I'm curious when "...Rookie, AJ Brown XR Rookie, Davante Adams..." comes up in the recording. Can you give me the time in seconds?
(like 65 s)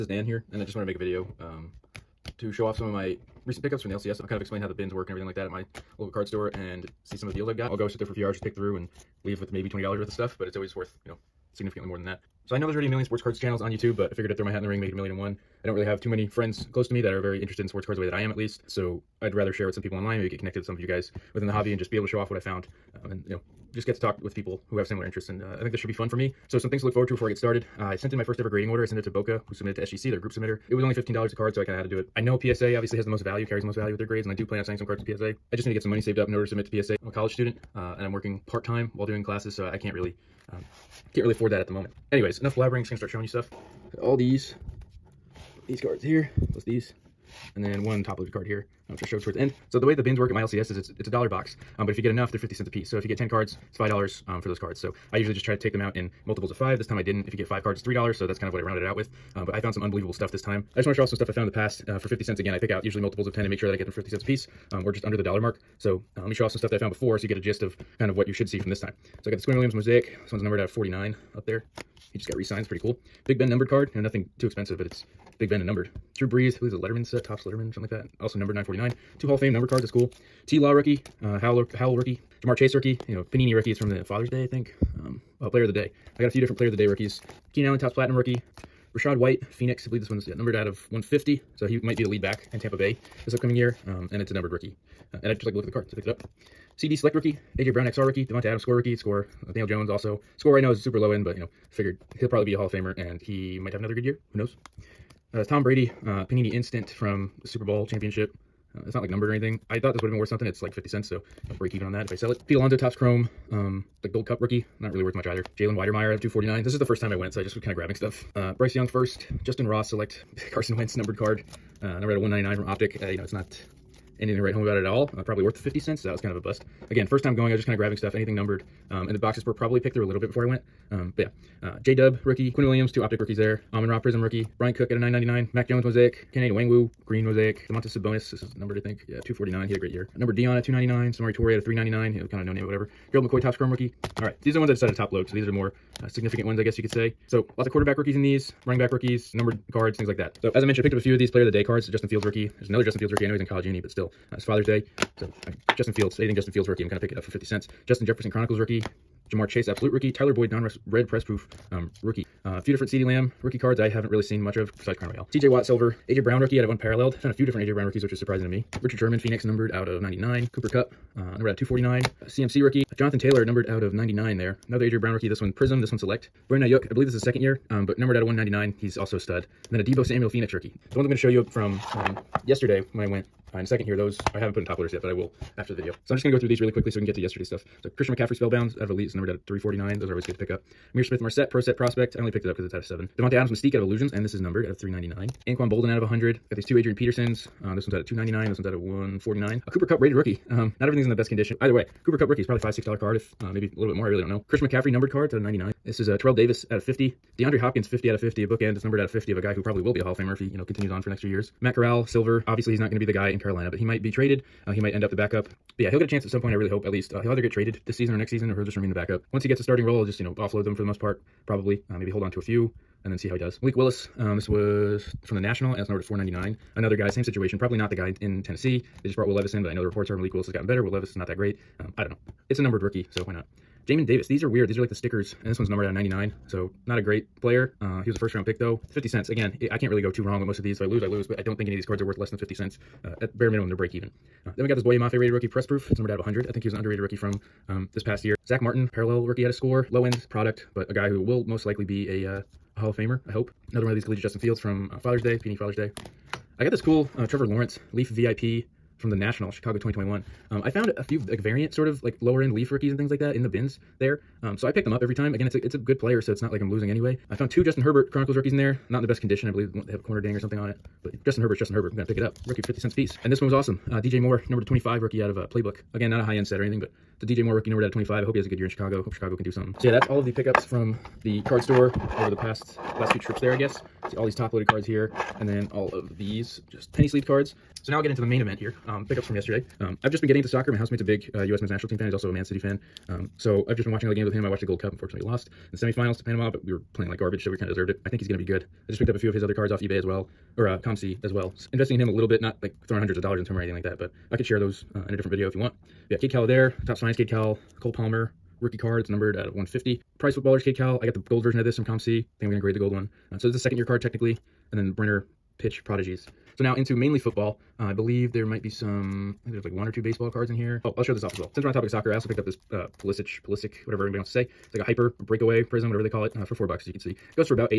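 97 s.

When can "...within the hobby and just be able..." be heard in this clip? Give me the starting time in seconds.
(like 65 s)
21 s.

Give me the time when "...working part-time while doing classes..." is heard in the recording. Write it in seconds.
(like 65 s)
38 s.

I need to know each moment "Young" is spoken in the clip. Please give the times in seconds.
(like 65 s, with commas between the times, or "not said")
118 s.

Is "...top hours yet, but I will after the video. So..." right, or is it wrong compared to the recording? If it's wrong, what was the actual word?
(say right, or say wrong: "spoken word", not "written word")
wrong: "loaders", not "hours".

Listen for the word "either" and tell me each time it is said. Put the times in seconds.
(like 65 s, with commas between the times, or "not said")
115 s, 201 s, 217 s.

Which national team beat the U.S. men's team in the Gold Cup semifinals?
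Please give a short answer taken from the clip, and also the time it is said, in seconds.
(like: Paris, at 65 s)
Panama, at 296 s.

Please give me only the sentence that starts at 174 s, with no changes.
Another Adrian Brown rookie, this one Prism, this one Select.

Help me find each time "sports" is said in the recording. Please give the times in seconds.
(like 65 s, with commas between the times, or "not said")
13 s, 17 s.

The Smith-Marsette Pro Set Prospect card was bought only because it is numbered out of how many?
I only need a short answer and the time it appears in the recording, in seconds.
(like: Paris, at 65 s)
7, at 192 s.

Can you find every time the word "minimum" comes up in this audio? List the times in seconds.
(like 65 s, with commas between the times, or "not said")
243 s.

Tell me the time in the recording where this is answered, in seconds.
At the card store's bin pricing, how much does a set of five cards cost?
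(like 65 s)
57 s.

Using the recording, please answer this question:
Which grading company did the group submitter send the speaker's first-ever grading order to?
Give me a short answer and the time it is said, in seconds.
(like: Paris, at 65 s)
SGC, at 29 s.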